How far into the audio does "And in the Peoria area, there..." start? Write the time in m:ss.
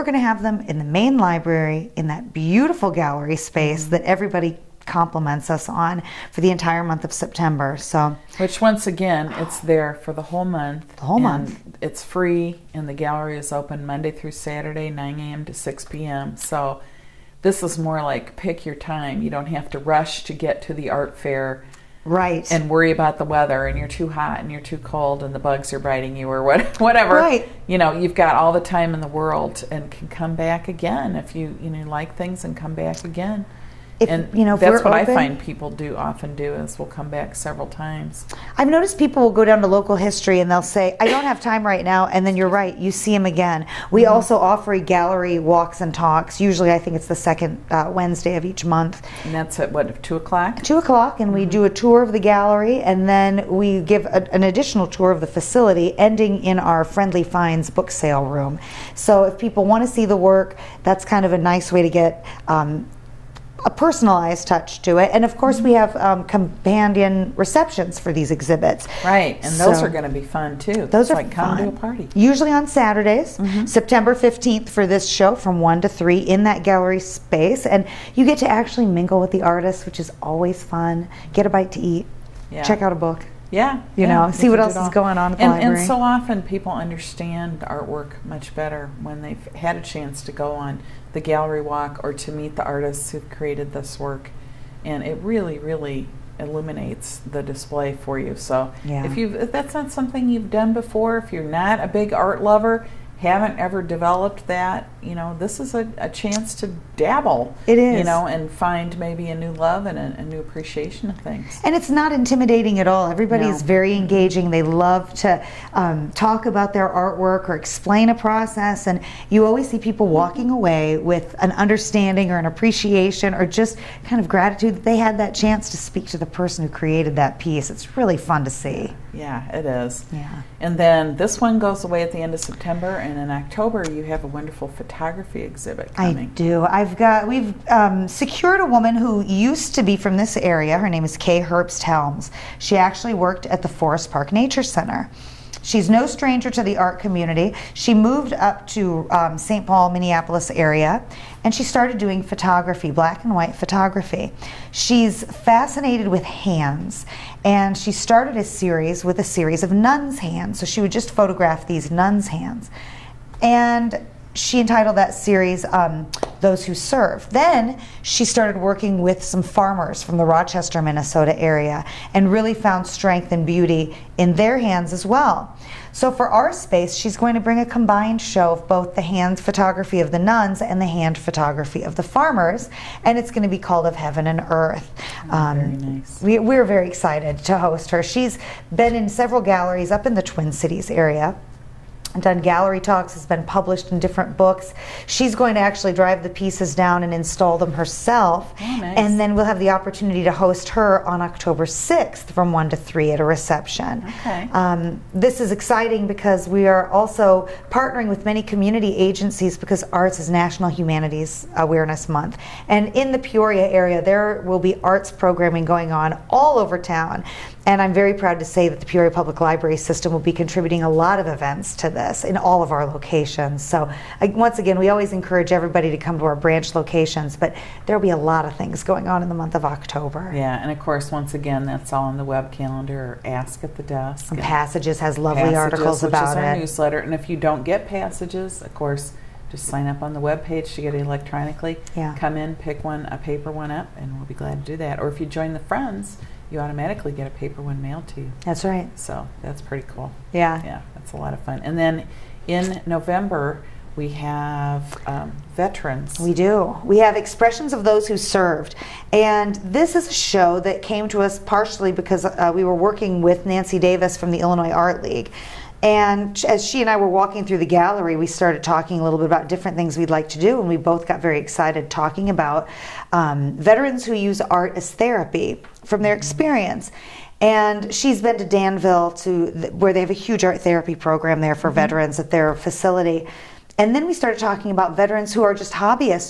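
3:32.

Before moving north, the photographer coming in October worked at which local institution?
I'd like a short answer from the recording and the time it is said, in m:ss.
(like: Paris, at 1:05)
Forest Park Nature Center, at 2:23.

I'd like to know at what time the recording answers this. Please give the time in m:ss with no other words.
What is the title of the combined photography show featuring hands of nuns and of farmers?
3:03.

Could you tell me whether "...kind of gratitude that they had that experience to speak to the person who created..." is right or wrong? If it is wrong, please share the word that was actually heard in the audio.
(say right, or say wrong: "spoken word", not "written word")
wrong: "chance", not "experience".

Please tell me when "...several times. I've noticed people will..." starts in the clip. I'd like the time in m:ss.
0:37.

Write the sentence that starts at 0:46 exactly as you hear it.
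Usually, I think it's the second uh, Wednesday of each month.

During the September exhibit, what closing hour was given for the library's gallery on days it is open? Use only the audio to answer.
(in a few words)
6 p.m.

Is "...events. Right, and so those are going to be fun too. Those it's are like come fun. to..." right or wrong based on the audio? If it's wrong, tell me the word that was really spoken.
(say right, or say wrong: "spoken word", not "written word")
wrong: "exhibits", not "events".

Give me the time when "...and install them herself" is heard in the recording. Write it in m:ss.
3:17.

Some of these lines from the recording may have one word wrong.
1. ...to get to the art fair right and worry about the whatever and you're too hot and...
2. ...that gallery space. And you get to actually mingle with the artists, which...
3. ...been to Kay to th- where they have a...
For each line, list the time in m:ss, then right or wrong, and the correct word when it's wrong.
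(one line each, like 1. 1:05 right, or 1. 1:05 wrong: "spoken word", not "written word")
1. 0:20 wrong: "weather", not "whatever"
2. 1:16 right
3. 4:38 wrong: "Danville", not "Kay".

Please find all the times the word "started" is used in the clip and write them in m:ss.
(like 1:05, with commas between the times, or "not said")
2:31, 2:37, 2:48, 4:28, 4:44.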